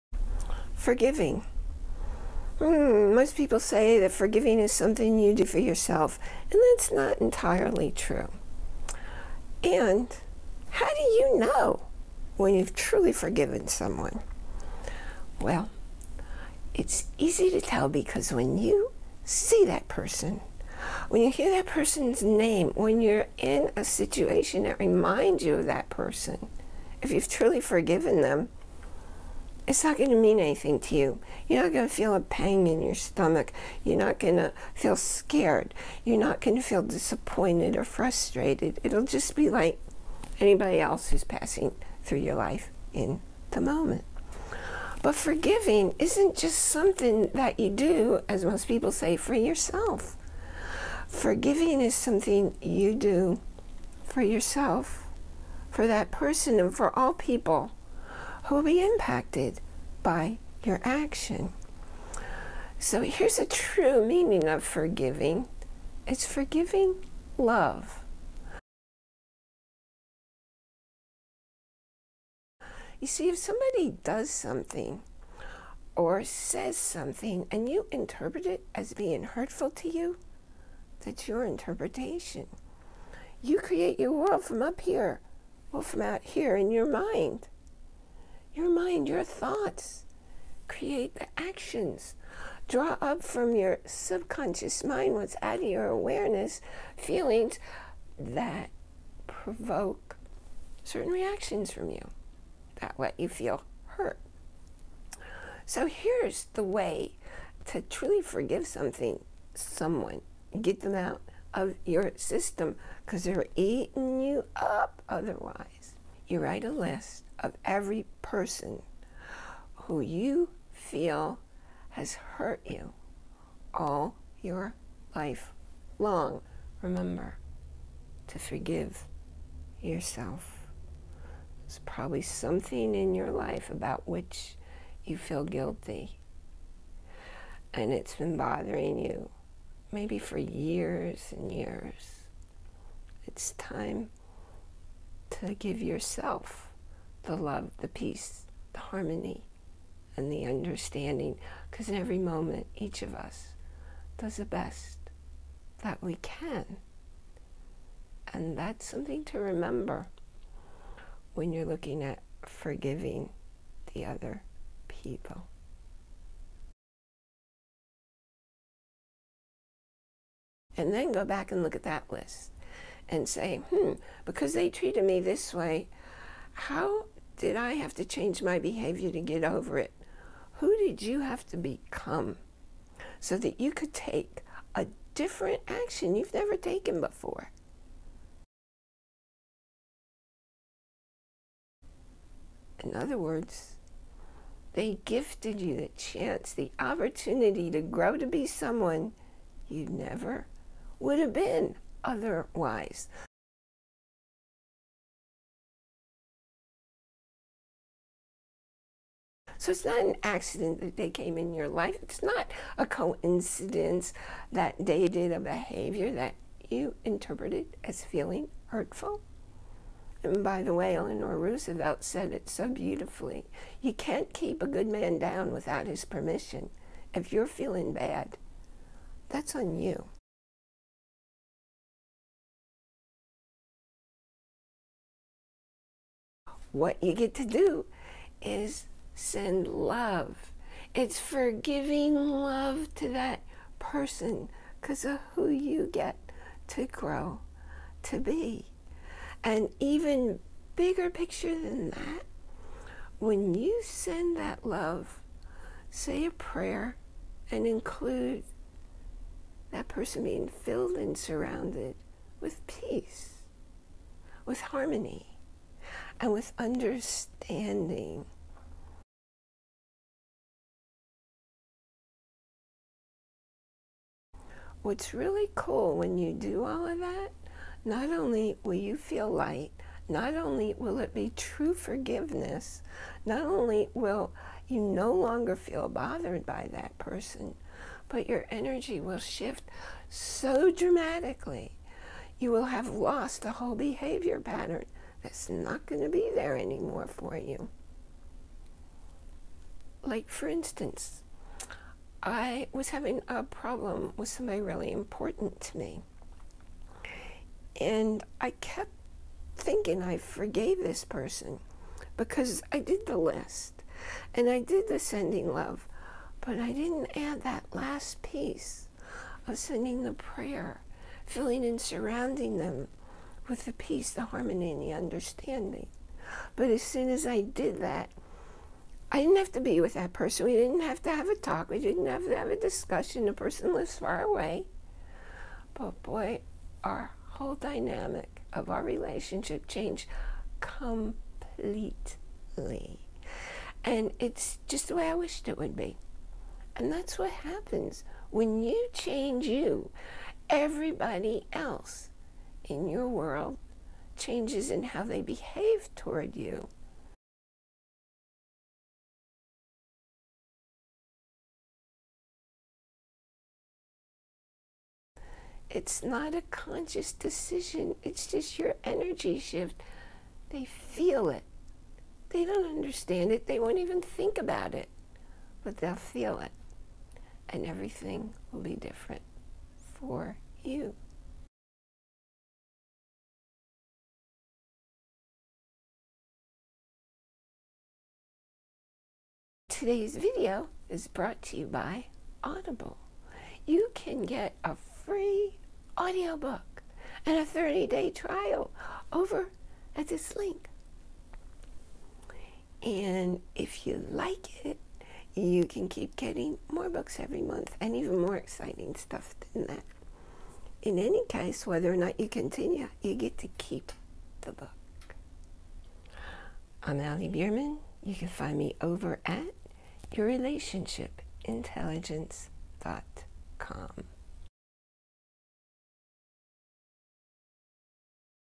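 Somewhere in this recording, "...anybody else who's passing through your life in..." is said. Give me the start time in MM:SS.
00:40.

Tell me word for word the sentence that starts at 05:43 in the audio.
And it's just the way I wished it would be.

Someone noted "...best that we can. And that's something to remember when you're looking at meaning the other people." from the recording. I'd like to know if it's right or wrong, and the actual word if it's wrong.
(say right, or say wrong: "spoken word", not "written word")
wrong: "forgiving", not "meaning".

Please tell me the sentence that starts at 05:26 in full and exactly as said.
But as soon as I did that, I didn't have to be with that person.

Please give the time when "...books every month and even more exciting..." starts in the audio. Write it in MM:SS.
06:46.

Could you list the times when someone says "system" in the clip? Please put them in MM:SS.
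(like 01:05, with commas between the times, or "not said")
01:52.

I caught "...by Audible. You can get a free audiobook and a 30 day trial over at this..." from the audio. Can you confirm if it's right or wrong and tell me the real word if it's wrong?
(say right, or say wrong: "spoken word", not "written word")
right.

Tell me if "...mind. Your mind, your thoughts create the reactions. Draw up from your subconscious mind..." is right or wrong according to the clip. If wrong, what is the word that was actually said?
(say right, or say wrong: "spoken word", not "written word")
wrong: "actions", not "reactions".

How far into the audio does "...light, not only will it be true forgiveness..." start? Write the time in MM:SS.
04:39.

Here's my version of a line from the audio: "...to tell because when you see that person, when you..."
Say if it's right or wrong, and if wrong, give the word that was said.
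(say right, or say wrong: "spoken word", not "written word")
right.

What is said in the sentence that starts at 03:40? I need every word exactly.
And by the way, Eleanor Roosevelt said it so beautifully.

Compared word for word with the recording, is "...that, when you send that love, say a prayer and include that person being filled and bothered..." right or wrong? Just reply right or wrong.
wrong.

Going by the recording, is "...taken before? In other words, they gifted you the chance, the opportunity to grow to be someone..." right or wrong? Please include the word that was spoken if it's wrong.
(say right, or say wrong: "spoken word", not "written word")
right.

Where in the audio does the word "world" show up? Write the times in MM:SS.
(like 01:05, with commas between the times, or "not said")
01:24, 05:53.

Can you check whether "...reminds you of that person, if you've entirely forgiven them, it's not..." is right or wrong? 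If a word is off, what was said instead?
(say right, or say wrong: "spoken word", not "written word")
wrong: "truly", not "entirely".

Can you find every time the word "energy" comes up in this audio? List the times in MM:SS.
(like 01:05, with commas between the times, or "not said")
04:48, 06:08.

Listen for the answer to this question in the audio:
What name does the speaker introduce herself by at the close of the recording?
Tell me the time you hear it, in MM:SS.
06:56.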